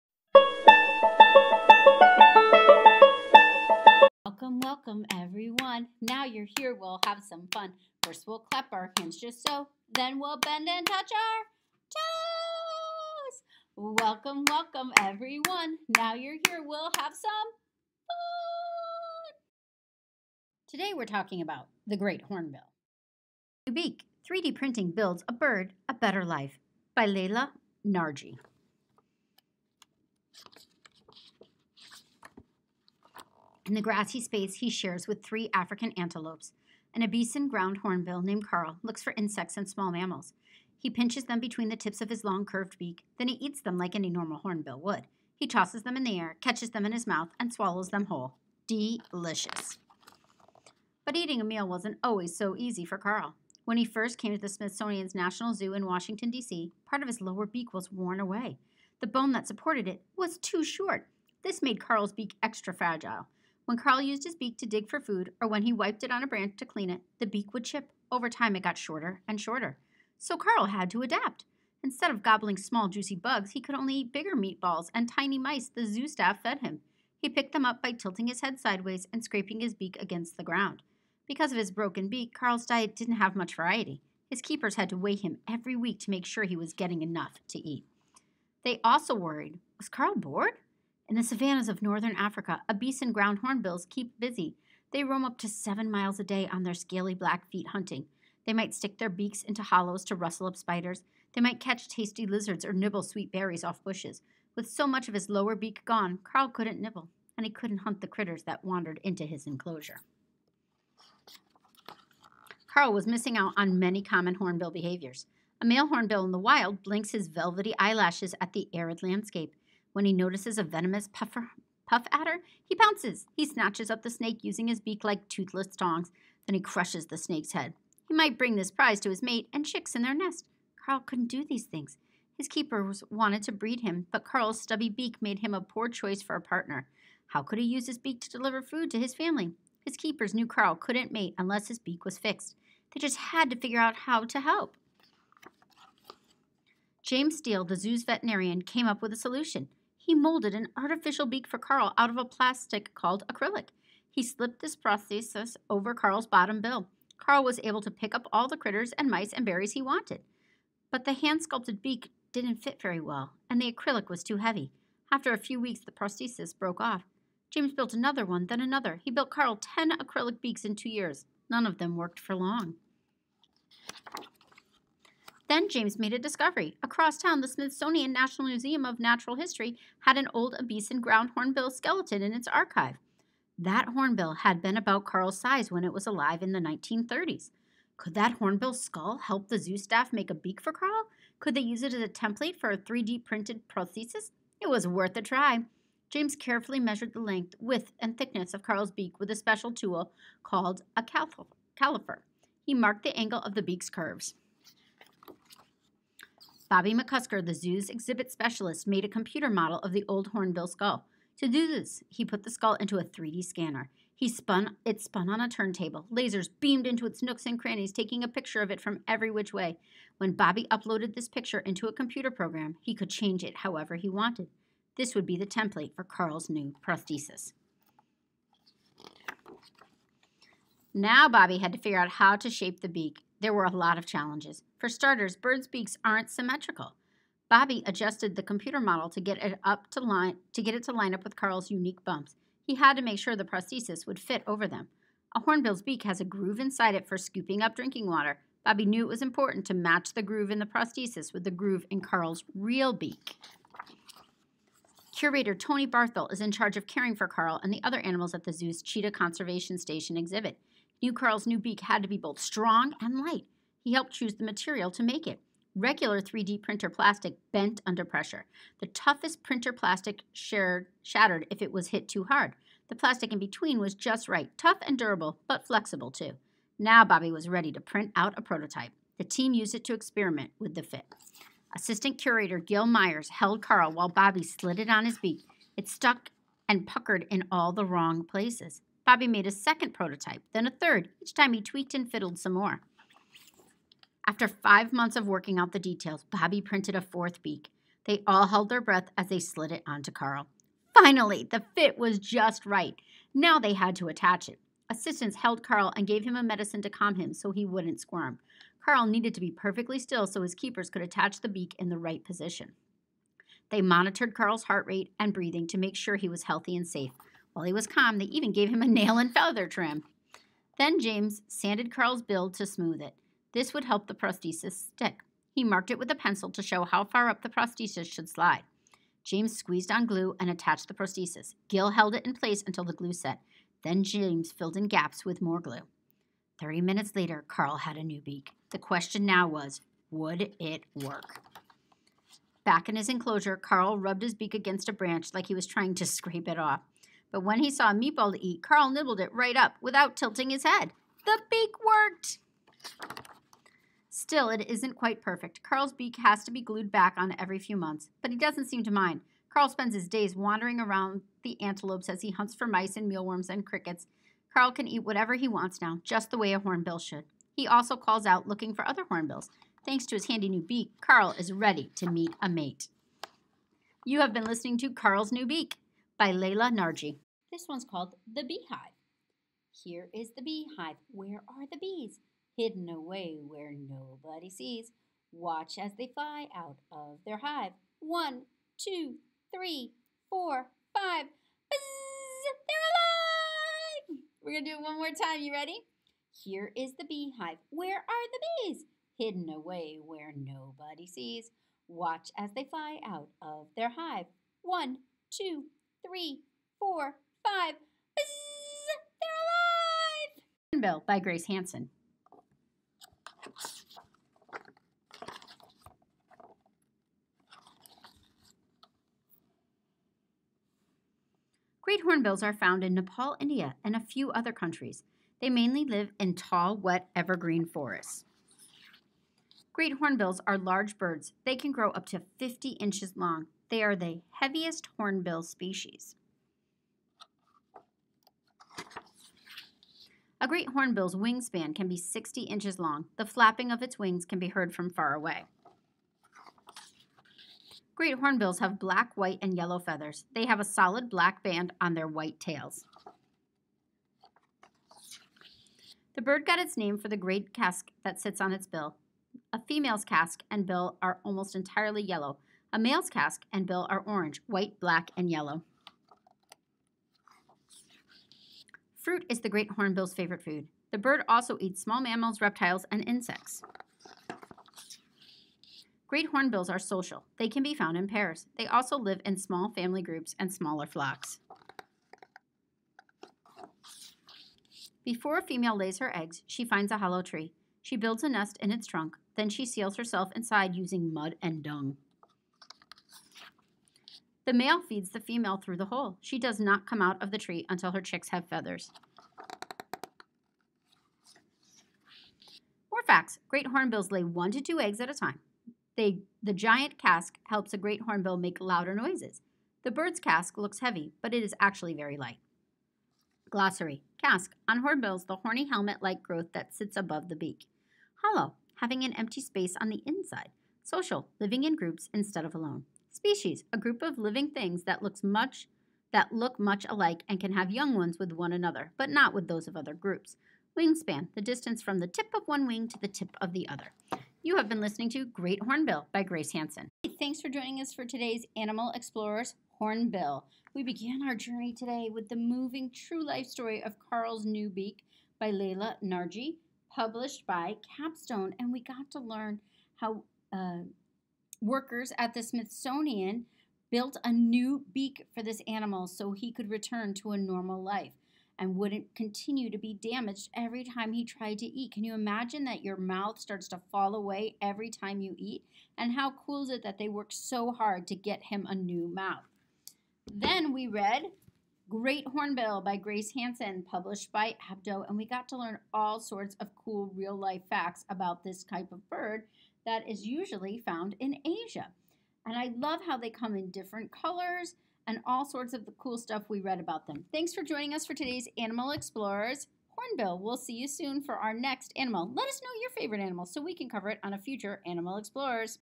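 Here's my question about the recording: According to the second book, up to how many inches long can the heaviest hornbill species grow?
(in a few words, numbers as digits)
50.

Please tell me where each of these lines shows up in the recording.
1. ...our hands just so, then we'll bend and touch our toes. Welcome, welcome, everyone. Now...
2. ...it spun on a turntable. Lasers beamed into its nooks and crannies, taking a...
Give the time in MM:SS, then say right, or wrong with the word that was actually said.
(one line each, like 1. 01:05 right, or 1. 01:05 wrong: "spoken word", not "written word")
1. 00:08 right
2. 03:34 right.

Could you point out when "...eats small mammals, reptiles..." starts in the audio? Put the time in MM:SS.
07:51.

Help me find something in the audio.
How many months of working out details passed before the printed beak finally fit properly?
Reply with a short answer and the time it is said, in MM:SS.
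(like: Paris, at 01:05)
5, at 04:54.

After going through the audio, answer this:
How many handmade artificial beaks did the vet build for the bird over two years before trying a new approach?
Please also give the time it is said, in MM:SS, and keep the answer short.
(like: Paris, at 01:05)
10, at 02:49.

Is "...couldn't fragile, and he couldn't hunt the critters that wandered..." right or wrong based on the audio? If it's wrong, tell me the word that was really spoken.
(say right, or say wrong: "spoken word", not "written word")
wrong: "nibble", not "fragile".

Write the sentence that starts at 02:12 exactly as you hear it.
His keepers wanted to breed him, but Karl's stubby beak made him a poor choice for a partner.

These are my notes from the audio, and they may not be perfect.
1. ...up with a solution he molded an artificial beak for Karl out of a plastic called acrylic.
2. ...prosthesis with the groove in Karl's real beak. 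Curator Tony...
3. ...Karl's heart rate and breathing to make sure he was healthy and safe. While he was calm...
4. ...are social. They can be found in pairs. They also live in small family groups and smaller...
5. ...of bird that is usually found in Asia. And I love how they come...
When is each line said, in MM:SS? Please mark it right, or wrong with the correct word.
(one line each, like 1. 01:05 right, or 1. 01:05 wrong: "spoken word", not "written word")
1. 02:28 right
2. 04:10 right
3. 05:14 right
4. 07:56 right
5. 09:38 right.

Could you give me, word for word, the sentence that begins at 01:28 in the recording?
They also worried was Karl bored?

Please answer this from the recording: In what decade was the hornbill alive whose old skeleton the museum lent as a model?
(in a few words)
1930s.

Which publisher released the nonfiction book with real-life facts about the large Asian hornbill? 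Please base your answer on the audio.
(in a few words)
Abdo.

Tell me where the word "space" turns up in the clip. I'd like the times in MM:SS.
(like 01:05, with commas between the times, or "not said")
00:34, 08:39.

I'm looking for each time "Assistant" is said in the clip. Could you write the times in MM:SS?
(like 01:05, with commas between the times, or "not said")
04:41, 05:04.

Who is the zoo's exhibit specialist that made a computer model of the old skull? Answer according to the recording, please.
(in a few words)
Bobby McCusker.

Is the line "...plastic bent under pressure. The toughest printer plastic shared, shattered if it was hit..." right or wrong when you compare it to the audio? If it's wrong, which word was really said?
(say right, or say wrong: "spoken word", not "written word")
right.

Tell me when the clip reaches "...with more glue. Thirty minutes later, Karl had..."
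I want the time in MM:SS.
05:35.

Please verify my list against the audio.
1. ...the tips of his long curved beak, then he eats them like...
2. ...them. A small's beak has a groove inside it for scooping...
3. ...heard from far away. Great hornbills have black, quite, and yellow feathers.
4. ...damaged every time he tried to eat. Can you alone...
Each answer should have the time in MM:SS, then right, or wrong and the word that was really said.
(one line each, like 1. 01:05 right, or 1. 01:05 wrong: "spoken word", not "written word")
1. 00:41 right
2. 04:04 wrong: "hornbill", not "small"
3. 07:24 wrong: "white", not "quite"
4. 09:19 wrong: "imagine", not "alone".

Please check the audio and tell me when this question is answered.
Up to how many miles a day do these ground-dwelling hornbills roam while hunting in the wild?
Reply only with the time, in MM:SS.
01:35.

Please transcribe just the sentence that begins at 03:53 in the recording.
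There were a lot of challenges.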